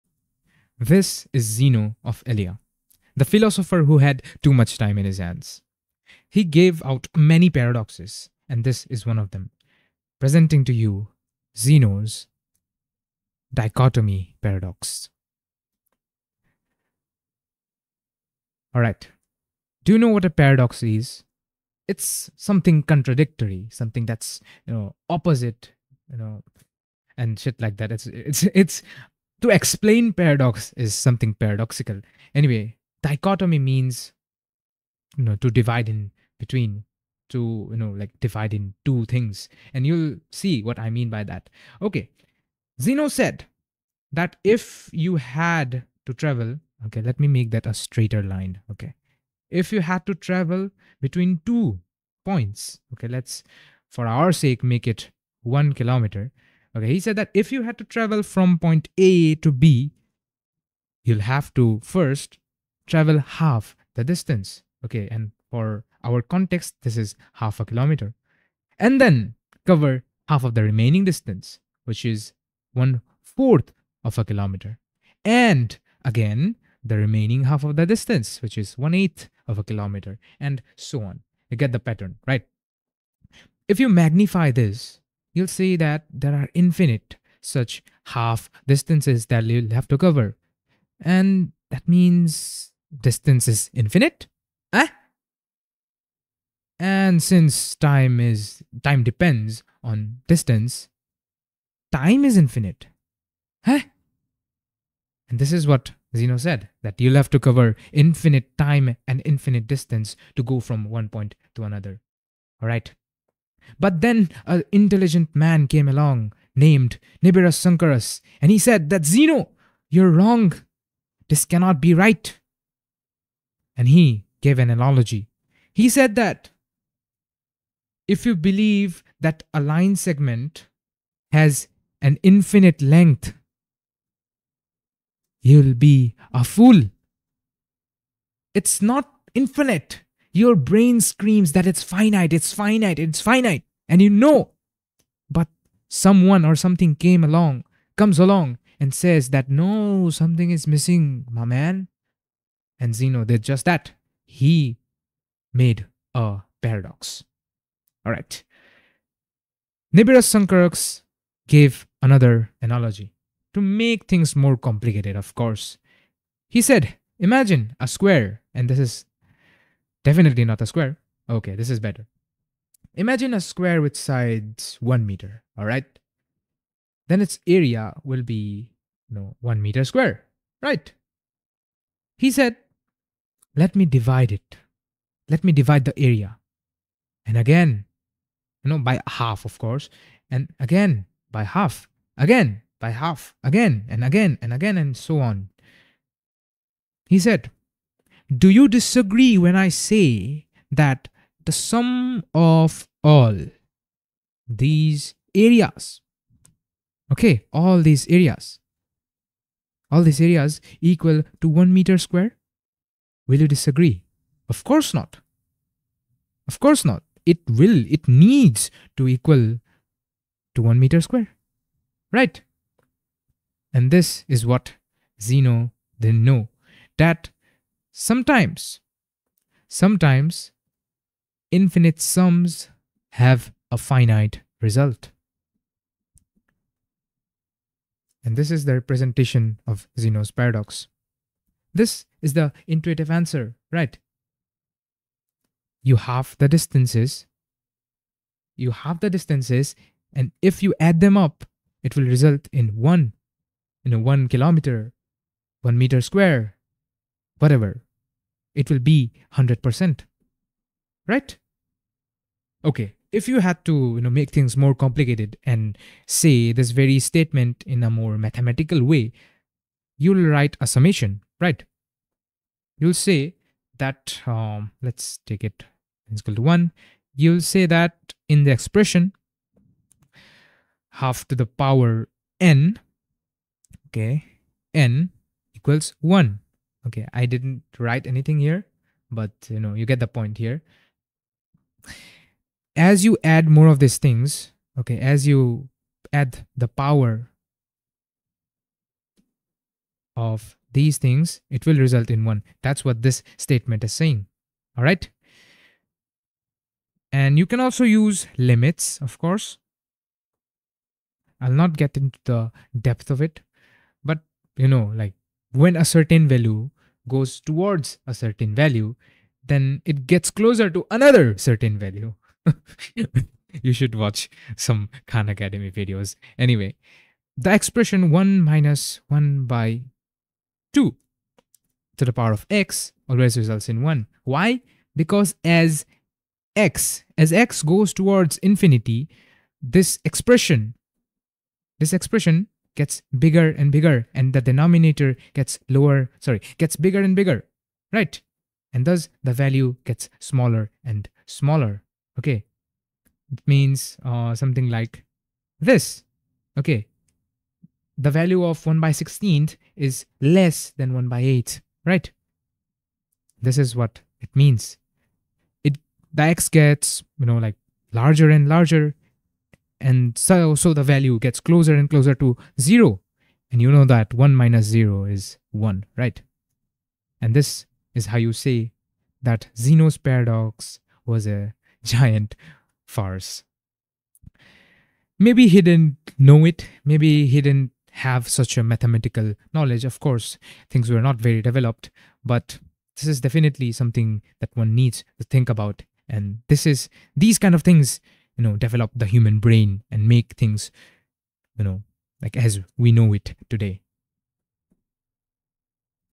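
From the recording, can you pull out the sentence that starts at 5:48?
And thus the value gets smaller and smaller, okay?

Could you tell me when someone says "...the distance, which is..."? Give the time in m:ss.
1:17.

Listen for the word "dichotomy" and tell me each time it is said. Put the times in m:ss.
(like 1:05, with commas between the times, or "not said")
0:13, 0:33.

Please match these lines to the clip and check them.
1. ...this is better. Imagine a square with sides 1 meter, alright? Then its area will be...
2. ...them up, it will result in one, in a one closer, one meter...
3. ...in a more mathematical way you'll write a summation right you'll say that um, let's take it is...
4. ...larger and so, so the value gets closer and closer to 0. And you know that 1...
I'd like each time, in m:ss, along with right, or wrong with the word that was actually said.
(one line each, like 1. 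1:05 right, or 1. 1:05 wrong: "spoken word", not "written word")
1. 2:51 right
2. 4:11 wrong: "kilometer", not "closer"
3. 4:27 right
4. 6:08 right.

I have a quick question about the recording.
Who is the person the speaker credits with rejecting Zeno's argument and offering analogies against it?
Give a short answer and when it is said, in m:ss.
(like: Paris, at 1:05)
Nibir Sankaras, at 1:57.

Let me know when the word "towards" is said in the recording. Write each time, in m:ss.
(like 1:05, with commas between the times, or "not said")
5:17, 5:37.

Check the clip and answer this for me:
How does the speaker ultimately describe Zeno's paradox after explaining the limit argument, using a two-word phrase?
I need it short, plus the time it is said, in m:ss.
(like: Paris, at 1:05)
giant farce, at 6:21.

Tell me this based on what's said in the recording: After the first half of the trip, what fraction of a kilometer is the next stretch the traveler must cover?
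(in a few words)
1/4.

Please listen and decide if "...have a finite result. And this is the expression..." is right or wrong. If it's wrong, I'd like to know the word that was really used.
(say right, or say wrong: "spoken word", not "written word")
wrong: "representation", not "expression".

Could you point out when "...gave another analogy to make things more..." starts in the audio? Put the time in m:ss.
2:41.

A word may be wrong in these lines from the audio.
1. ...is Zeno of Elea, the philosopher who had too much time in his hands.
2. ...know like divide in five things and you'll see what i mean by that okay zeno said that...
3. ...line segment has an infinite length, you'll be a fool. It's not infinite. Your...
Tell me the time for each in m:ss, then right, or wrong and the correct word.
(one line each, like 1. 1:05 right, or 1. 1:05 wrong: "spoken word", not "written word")
1. 0:01 right
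2. 0:37 wrong: "two", not "five"
3. 2:09 right.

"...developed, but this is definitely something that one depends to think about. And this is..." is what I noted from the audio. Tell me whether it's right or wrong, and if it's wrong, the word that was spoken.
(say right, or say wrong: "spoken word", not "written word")
wrong: "needs", not "depends".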